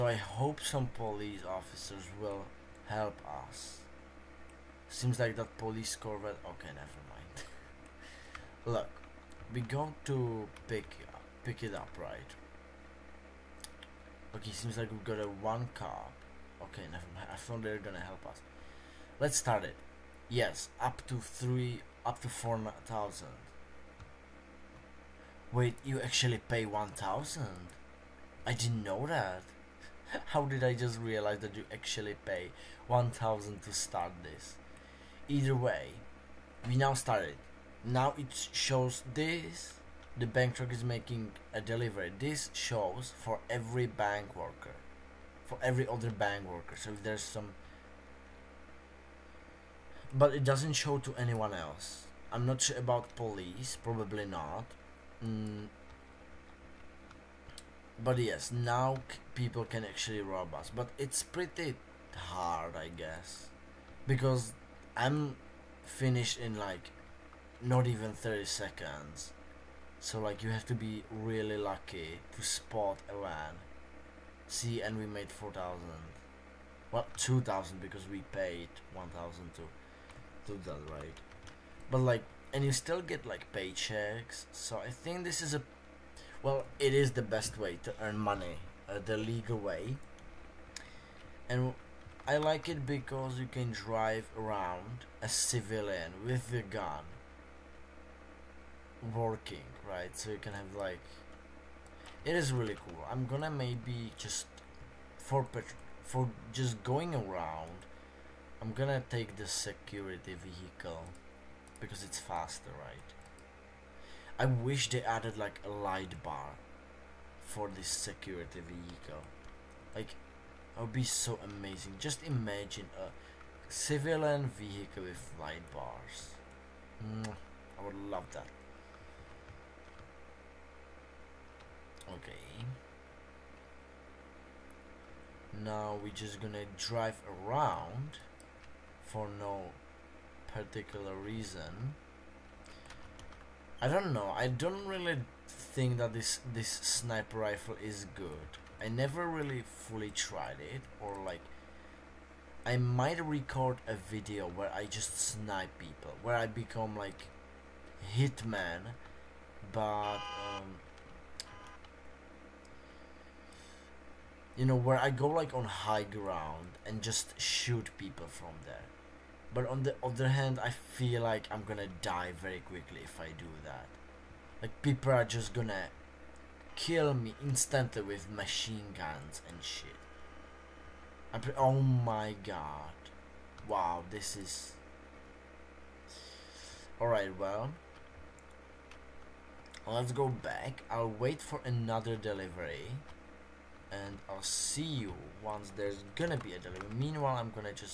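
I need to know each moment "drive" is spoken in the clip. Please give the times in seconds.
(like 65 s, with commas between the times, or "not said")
93 s, 136 s.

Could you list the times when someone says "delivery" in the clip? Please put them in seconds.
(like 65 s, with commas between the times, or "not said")
41 s, 192 s, 196 s.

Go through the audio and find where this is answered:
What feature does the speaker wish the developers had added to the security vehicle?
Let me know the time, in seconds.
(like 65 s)
115 s.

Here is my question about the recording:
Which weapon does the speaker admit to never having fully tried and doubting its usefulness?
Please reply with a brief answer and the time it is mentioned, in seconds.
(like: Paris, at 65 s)
Sniper rifle, at 146 s.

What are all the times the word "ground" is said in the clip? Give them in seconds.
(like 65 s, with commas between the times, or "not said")
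166 s.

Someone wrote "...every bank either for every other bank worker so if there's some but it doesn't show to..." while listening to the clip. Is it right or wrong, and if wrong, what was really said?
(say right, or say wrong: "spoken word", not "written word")
wrong: "worker", not "either".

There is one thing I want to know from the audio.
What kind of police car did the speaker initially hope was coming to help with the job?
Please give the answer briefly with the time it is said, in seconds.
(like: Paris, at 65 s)
Corvette, at 5 s.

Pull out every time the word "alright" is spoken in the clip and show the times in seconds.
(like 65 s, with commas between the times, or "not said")
186 s.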